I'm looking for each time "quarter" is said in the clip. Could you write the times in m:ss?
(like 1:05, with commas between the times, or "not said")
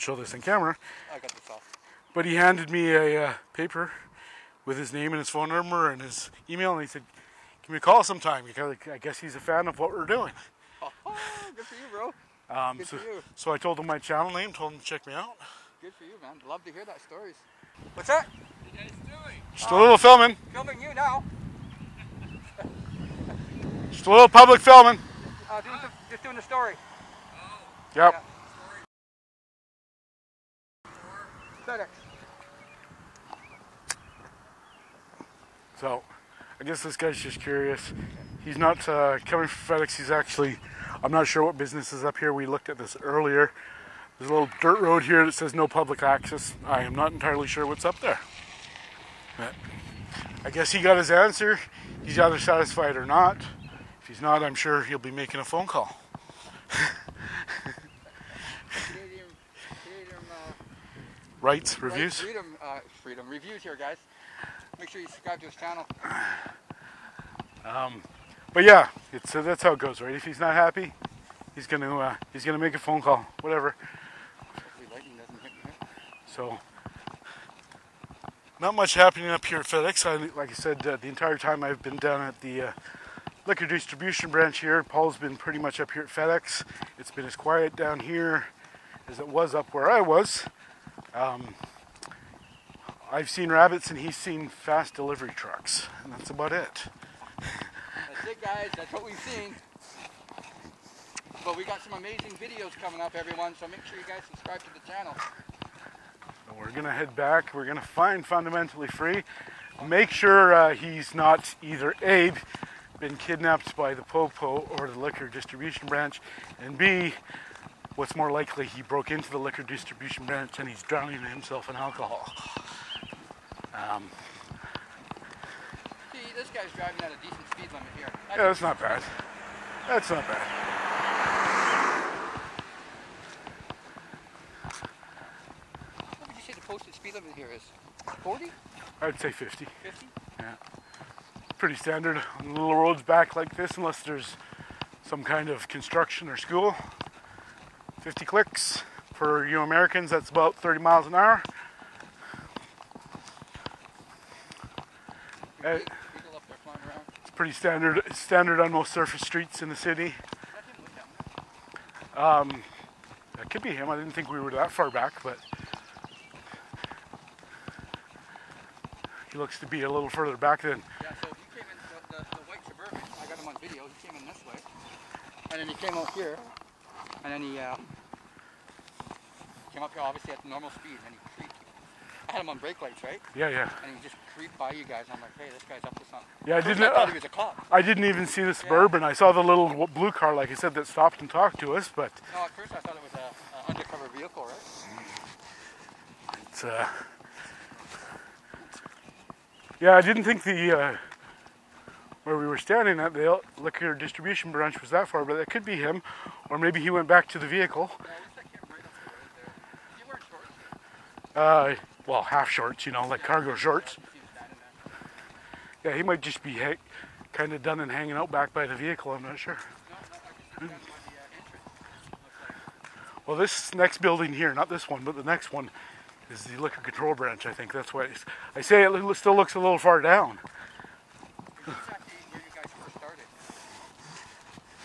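not said.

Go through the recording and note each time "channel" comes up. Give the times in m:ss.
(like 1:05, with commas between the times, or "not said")
0:13, 1:05, 1:44.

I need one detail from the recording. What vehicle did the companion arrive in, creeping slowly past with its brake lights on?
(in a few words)
white suburban.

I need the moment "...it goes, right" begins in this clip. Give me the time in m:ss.
1:09.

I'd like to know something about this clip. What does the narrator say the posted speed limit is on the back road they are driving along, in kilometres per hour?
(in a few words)
50.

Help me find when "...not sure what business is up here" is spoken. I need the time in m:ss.
0:41.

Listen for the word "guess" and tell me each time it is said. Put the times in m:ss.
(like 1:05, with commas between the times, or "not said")
0:08, 0:36, 0:50.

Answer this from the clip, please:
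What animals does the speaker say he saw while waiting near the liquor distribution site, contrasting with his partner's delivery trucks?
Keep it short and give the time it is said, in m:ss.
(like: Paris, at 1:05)
rabbits, at 1:33.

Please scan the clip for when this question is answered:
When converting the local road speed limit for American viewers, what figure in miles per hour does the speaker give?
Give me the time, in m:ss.
2:30.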